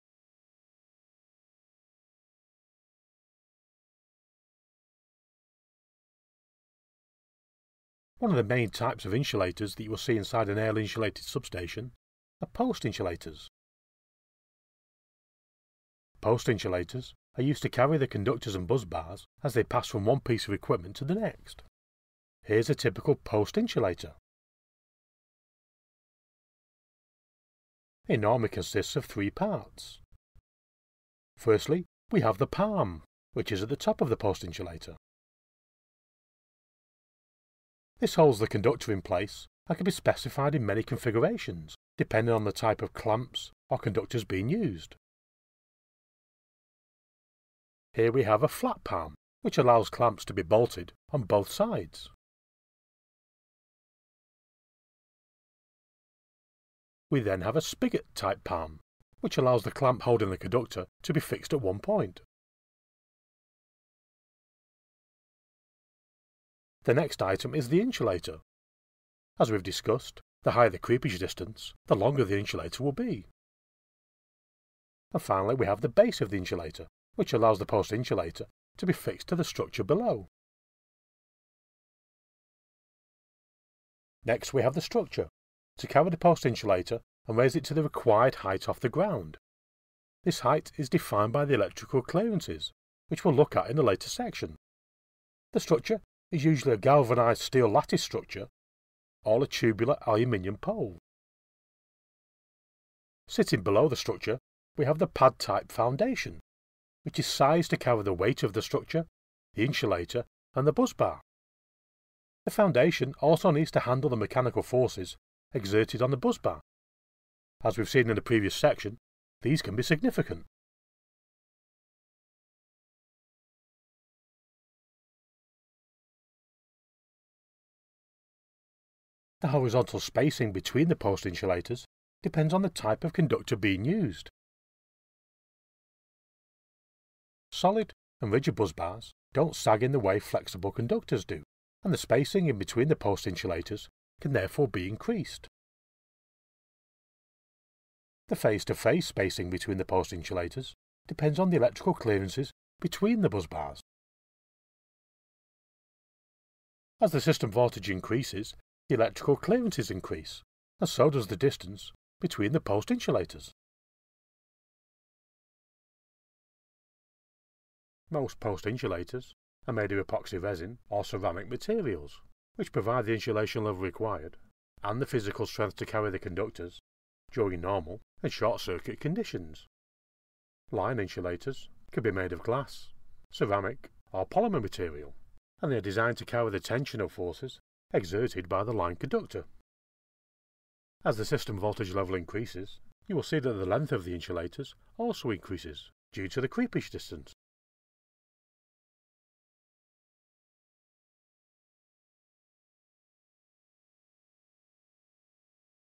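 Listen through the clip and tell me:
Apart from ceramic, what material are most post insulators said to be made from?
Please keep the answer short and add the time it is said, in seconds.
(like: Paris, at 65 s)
Epoxy resin, at 170 s.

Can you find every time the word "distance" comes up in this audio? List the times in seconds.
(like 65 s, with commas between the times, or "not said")
71 s, 161 s, 196 s.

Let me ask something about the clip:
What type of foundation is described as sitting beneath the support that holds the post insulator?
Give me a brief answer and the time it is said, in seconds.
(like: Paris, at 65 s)
Pad-type foundation, at 105 s.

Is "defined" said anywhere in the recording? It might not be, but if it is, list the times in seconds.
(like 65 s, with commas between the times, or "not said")
90 s.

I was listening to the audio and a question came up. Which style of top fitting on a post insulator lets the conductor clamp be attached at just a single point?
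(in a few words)
Spigot type palm.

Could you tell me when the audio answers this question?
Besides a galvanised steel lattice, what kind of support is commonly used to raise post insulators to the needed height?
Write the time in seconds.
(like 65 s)
99 s.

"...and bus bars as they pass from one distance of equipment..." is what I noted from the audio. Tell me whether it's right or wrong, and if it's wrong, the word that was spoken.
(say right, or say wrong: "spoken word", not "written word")
wrong: "piece", not "distance".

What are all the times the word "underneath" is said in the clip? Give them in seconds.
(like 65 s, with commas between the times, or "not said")
not said.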